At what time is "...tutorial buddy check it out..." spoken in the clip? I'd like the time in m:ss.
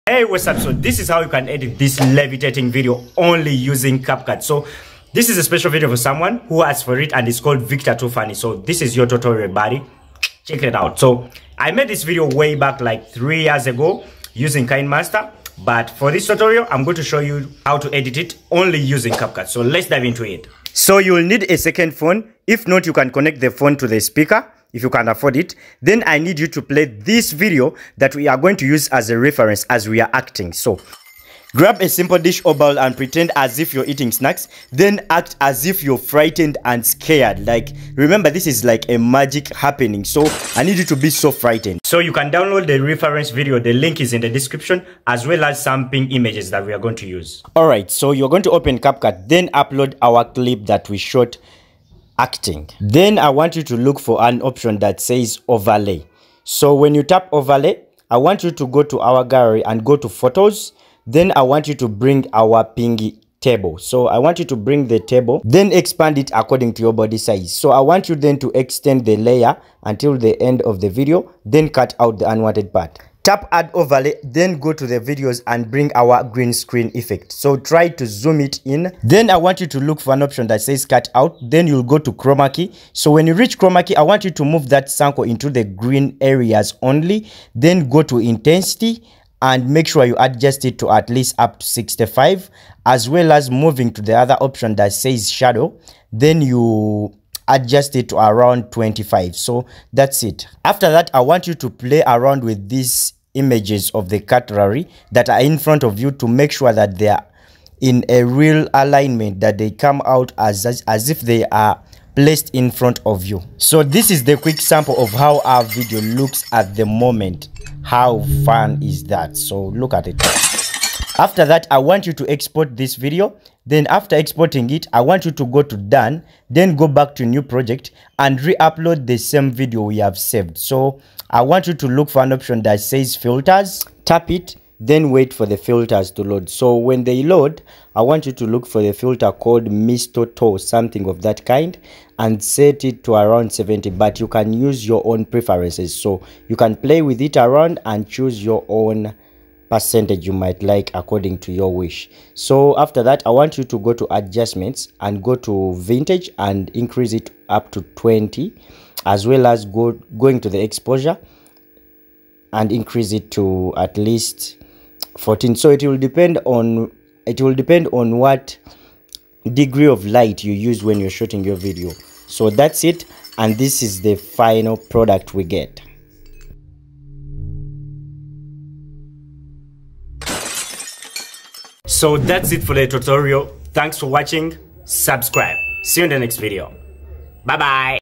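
0:09.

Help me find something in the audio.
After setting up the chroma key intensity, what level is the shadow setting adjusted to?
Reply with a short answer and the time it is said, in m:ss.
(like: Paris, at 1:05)
25, at 1:38.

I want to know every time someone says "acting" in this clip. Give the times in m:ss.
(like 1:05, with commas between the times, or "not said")
0:30, 0:52.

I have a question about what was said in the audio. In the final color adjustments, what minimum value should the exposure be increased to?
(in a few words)
14.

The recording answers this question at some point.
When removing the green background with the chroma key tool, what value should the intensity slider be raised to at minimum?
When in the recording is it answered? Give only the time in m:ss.
1:31.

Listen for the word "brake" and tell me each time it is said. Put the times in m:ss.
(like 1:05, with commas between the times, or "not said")
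not said.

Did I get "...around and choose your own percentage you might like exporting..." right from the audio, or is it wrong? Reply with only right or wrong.
wrong.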